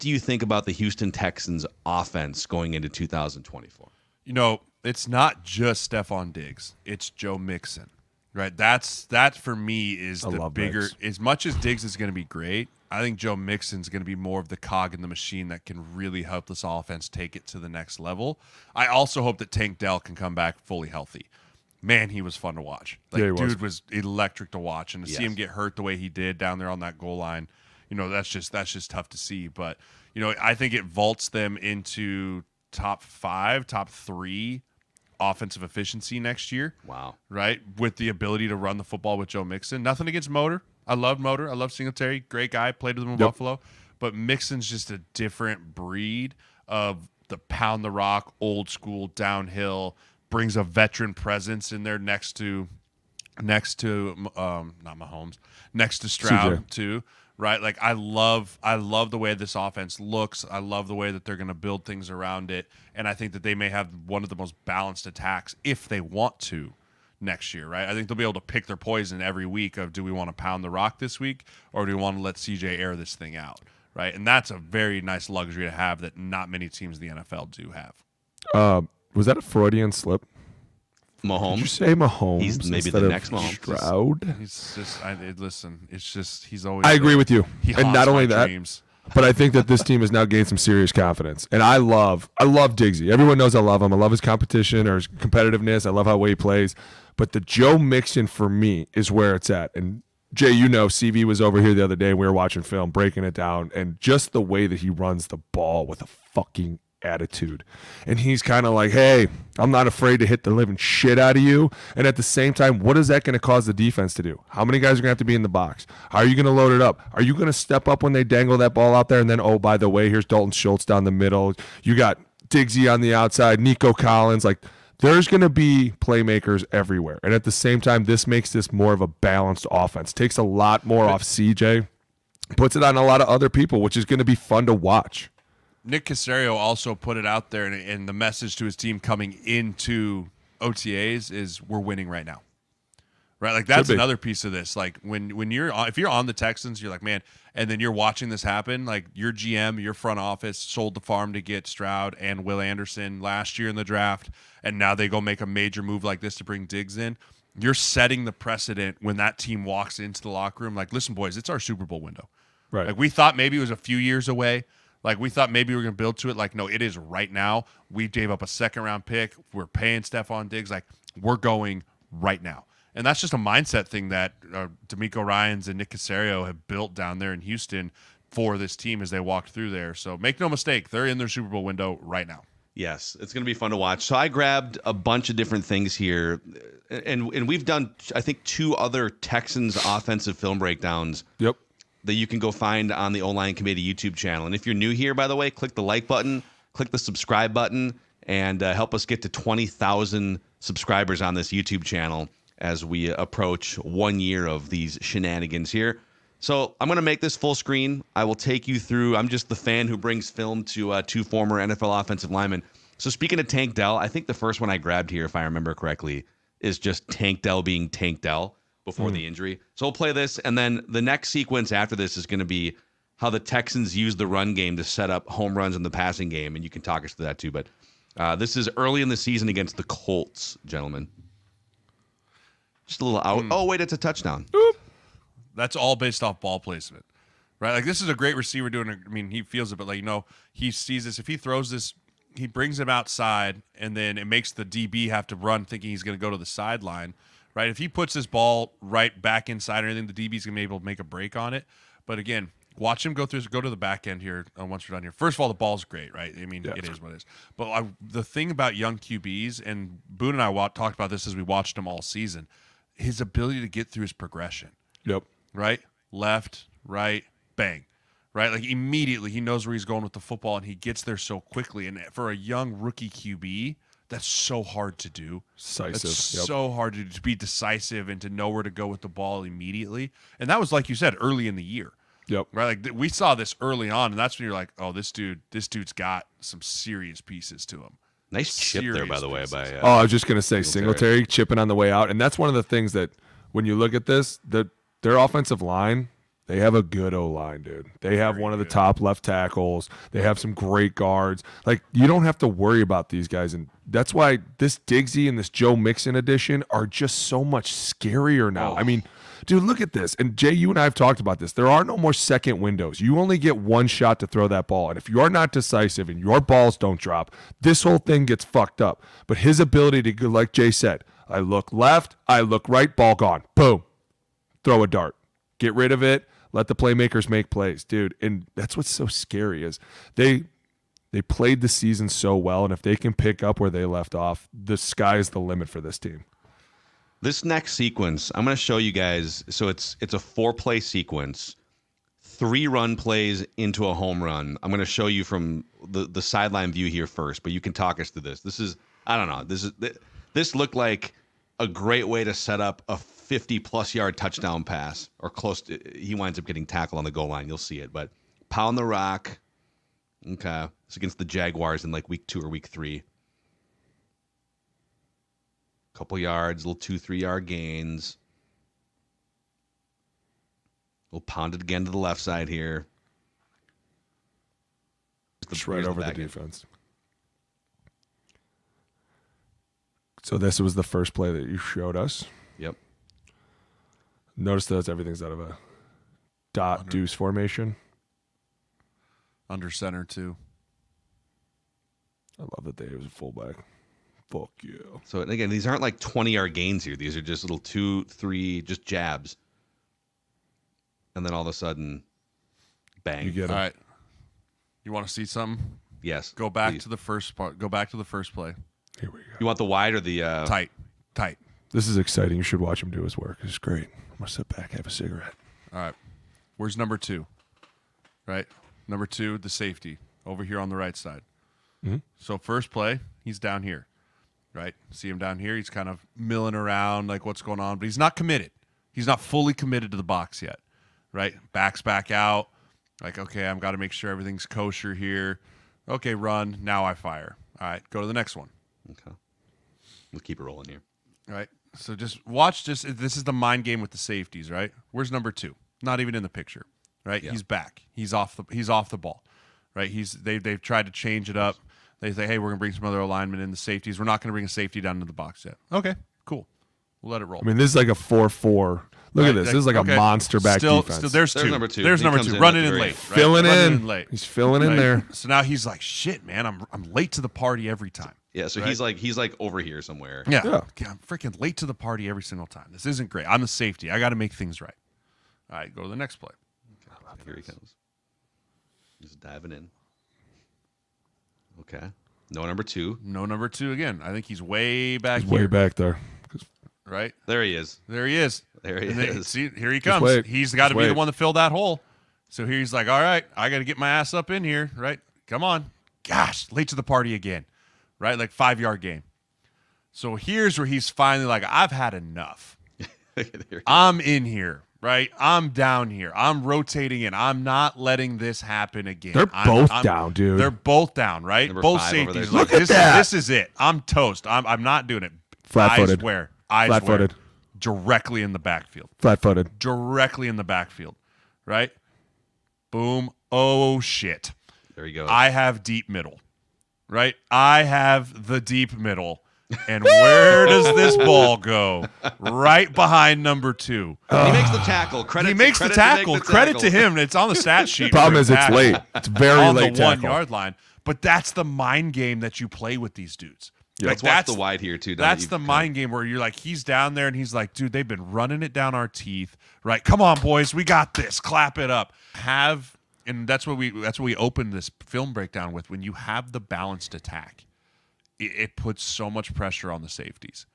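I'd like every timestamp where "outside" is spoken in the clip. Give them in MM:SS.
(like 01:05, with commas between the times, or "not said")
02:03, 04:02.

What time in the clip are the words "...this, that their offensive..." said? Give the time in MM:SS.
04:54.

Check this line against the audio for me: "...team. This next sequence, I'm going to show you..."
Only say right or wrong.
right.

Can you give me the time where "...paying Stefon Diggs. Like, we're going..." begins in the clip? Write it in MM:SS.
02:49.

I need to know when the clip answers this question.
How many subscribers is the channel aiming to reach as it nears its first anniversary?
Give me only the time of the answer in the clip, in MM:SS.
03:19.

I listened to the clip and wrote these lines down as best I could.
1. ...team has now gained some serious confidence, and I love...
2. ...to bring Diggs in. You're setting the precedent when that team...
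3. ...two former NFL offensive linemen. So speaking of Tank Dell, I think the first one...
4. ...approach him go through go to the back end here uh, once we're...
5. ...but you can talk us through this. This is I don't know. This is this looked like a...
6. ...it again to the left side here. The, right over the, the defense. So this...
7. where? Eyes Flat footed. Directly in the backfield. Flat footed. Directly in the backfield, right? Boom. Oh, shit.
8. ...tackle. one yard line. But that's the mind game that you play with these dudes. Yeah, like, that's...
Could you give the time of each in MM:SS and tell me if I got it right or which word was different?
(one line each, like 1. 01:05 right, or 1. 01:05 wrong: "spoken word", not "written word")
1. 01:29 right
2. 02:36 right
3. 03:31 right
4. 04:12 wrong: "watch", not "approach"
5. 05:47 right
6. 06:11 right
7. 08:36 right
8. 08:59 right.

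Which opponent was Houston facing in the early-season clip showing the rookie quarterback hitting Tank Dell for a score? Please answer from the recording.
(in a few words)
Colts.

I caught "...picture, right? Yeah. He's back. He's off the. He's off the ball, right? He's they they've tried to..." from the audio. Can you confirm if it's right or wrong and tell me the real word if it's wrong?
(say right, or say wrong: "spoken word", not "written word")
right.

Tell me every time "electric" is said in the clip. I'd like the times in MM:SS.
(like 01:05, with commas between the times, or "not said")
00:23.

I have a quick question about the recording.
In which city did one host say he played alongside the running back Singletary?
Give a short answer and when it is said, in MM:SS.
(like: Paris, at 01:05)
Buffalo, at 00:43.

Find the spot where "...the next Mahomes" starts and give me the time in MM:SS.
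01:22.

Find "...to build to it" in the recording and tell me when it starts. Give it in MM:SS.
02:45.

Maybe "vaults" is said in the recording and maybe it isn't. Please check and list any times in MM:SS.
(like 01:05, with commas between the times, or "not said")
00:30.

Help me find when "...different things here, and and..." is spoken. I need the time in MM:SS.
03:05.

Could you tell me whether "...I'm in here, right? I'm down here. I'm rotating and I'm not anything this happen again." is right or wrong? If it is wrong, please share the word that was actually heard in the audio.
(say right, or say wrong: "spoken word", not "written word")
wrong: "letting", not "anything".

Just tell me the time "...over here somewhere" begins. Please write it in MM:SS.
07:49.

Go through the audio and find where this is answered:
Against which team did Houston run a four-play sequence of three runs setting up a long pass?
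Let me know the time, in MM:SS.
06:01.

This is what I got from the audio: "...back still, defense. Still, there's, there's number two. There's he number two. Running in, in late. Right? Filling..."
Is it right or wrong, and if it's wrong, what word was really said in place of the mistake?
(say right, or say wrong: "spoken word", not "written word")
right.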